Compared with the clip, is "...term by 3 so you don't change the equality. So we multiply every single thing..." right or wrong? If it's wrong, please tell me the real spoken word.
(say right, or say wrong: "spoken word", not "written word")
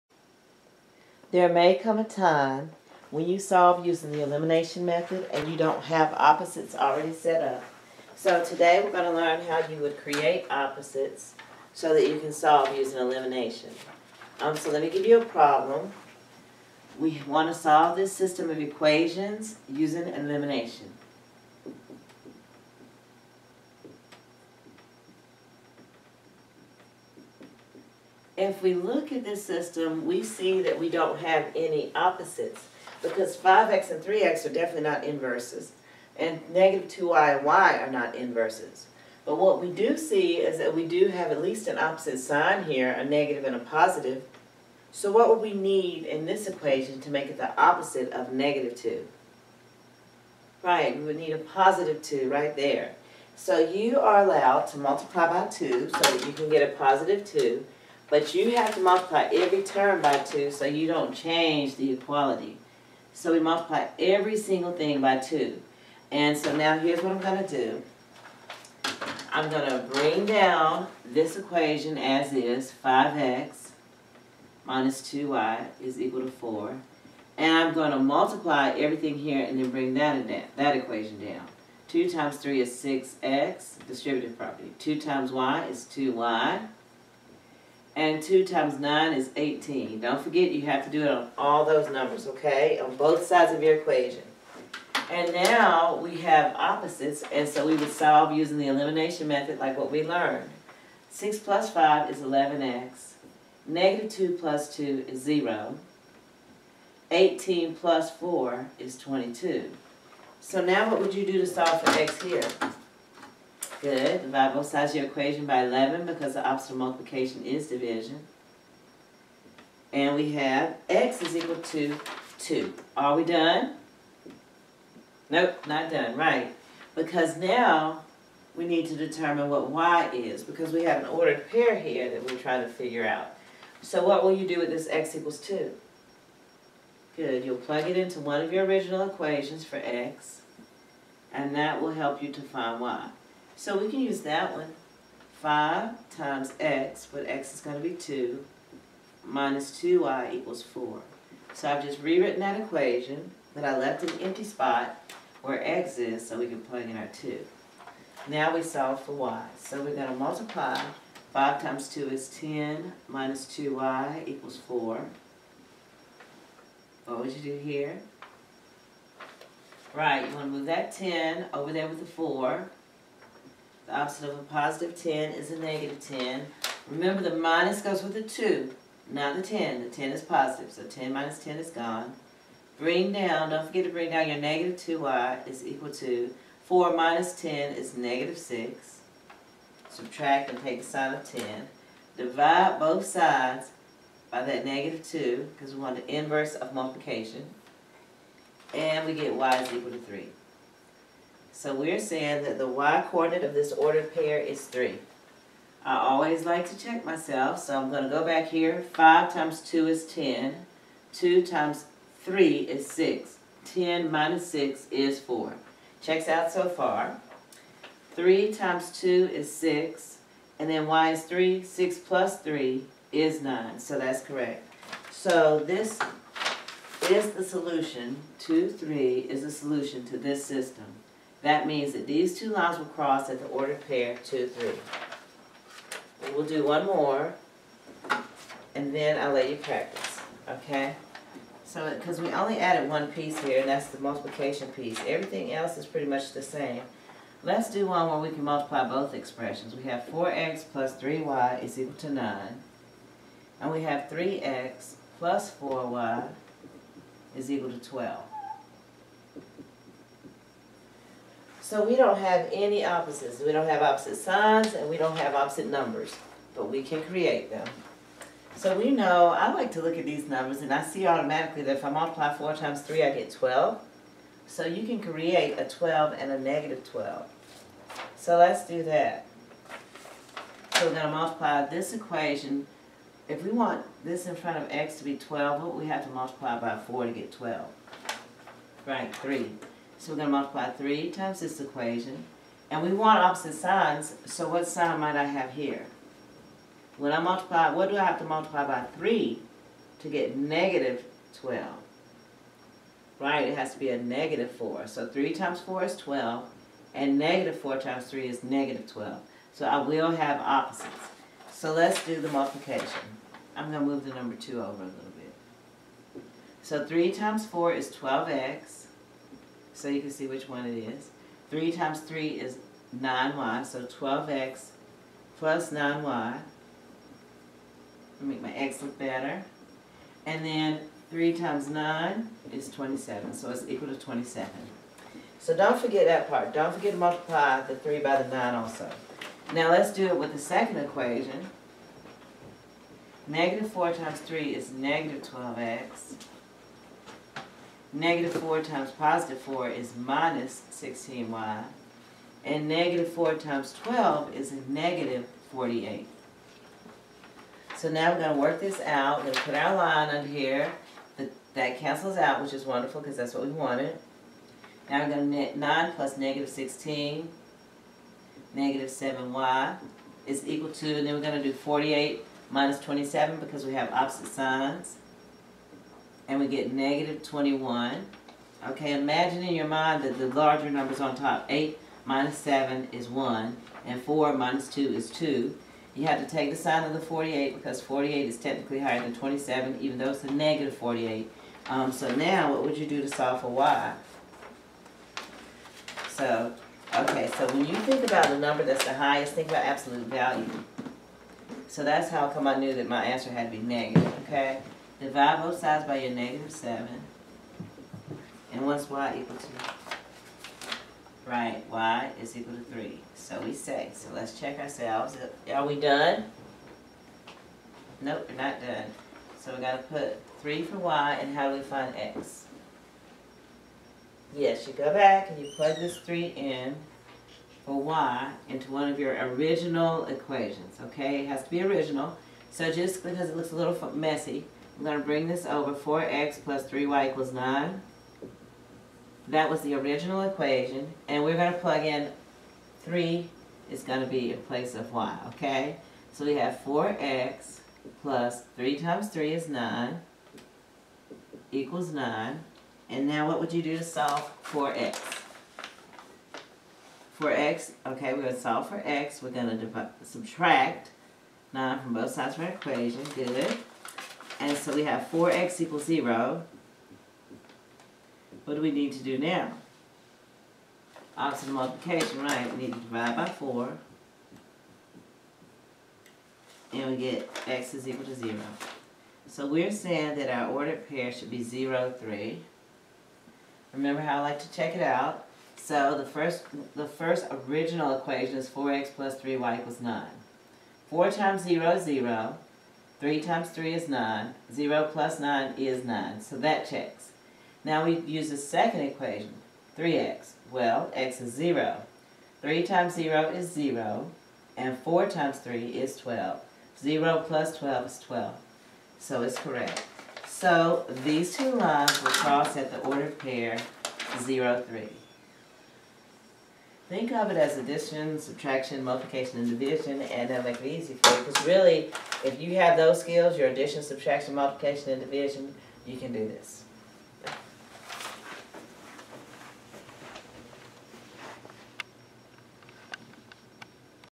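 wrong: "2", not "3".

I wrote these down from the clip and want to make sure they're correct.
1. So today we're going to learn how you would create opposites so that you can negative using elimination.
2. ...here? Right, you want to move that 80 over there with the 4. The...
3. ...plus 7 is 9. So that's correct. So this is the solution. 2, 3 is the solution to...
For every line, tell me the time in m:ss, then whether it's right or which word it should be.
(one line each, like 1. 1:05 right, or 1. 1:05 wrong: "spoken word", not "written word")
1. 0:08 wrong: "solve", not "negative"
2. 2:47 wrong: "10", not "80"
3. 3:41 wrong: "3", not "7".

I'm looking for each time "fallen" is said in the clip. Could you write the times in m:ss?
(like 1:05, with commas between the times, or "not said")
not said.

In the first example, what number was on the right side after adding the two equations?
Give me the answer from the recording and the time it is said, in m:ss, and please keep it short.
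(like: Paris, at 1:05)
22, at 1:48.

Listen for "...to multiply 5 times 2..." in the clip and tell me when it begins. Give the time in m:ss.
2:40.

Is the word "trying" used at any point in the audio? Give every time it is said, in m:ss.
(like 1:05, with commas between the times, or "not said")
2:12.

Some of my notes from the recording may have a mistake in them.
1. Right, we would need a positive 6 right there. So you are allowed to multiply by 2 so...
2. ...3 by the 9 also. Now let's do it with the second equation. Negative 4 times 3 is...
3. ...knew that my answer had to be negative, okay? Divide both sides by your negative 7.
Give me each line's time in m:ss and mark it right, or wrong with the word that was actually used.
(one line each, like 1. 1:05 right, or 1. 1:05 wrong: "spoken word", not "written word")
1. 0:50 wrong: "2", not "6"
2. 5:37 right
3. 6:42 right.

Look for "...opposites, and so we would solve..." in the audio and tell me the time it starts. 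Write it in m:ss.
1:36.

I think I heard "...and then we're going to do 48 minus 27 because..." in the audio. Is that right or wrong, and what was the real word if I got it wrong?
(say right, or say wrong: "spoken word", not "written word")
right.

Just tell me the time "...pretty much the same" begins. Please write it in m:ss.
4:05.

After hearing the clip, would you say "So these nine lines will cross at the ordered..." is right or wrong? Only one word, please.
wrong.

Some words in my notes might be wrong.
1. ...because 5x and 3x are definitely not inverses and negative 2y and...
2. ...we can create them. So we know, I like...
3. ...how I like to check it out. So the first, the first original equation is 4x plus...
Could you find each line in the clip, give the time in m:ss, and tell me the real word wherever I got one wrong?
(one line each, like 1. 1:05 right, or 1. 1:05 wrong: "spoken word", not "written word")
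1. 0:33 right
2. 4:26 right
3. 8:04 right.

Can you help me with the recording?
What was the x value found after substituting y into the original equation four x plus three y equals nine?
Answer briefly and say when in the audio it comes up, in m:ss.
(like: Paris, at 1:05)
0, at 7:57.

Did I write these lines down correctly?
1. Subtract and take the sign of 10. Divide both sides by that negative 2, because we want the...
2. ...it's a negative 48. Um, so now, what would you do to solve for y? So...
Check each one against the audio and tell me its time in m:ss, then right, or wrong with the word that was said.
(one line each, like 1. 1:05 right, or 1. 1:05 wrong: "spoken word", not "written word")
1. 3:09 right
2. 6:30 right.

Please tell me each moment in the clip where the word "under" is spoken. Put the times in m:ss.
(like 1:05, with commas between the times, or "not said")
6:00.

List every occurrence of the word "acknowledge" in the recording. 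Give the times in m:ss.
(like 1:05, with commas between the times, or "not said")
not said.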